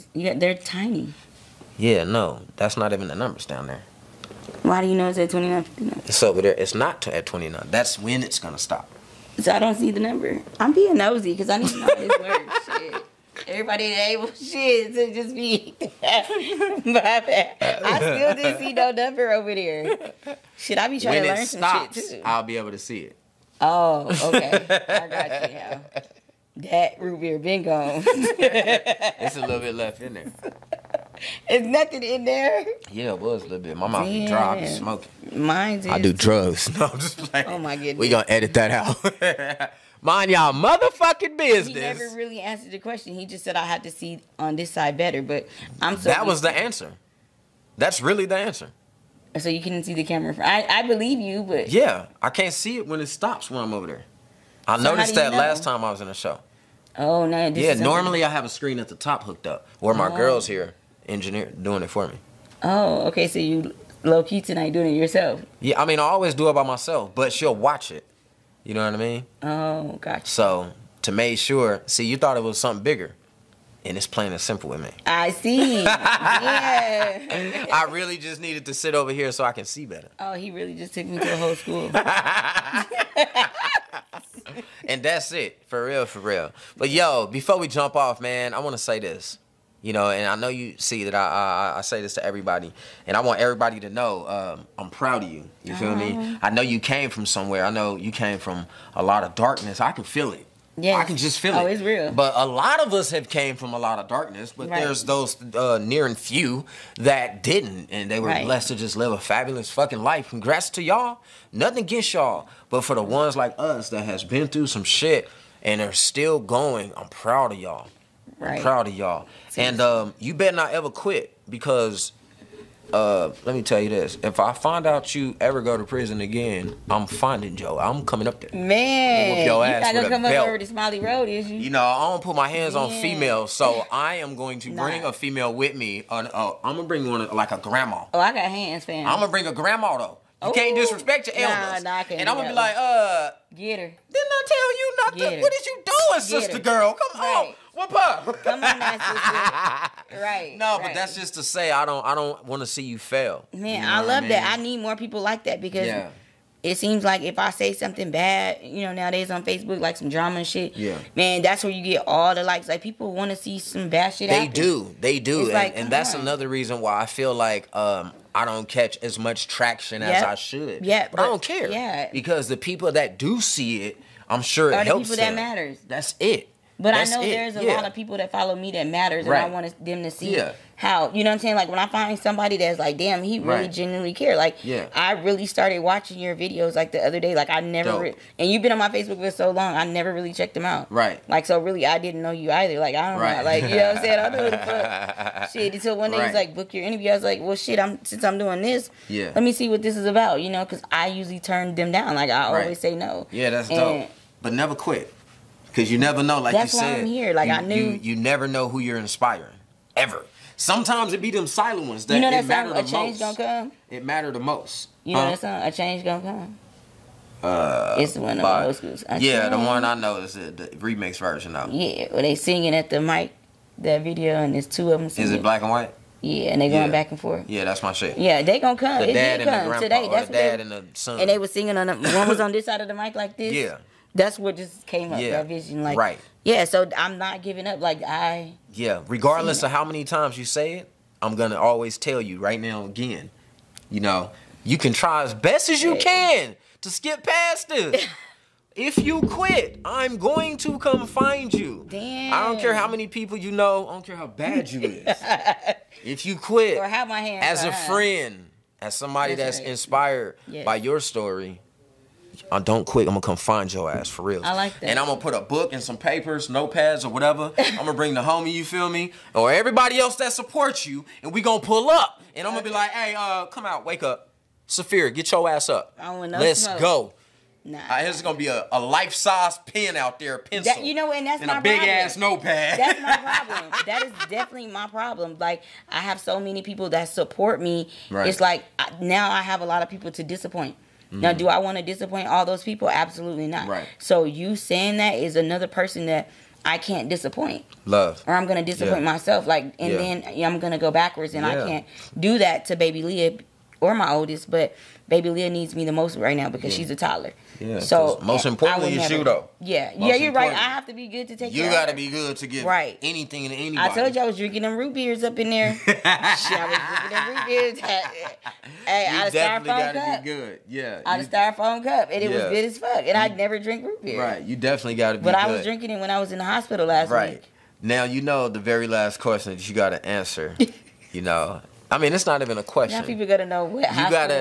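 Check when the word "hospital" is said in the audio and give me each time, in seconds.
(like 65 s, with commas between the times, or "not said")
326 s, 333 s.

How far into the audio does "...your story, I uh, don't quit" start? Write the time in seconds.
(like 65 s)
260 s.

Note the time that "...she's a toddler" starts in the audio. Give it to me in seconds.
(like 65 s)
306 s.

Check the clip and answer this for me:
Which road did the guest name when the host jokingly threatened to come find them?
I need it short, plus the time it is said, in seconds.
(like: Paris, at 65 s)
Smiley Road, at 130 s.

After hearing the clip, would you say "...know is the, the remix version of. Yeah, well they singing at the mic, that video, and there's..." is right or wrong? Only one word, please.
right.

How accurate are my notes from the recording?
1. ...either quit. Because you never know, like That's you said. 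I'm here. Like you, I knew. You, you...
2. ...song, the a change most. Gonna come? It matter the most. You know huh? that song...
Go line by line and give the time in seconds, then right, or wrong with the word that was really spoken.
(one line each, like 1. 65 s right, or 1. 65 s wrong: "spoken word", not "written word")
1. 204 s wrong: "never", not "either"
2. 212 s right.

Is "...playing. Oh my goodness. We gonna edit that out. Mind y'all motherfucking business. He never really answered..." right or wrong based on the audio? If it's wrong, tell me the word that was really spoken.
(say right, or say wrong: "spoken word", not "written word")
right.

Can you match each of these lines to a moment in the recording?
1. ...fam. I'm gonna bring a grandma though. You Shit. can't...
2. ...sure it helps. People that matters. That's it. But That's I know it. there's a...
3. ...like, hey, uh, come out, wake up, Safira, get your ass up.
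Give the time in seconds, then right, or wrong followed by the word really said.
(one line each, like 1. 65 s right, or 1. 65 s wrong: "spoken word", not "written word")
1. 138 s wrong: "Ooh", not "Shit"
2. 174 s right
3. 272 s right.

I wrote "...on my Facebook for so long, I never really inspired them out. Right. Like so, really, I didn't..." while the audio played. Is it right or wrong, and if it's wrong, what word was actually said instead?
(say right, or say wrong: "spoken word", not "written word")
wrong: "checked", not "inspired".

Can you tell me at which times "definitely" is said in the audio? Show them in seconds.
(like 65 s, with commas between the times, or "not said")
284 s, 324 s.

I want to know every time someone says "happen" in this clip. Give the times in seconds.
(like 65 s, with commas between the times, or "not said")
164 s.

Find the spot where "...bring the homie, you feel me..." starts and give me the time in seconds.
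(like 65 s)
267 s.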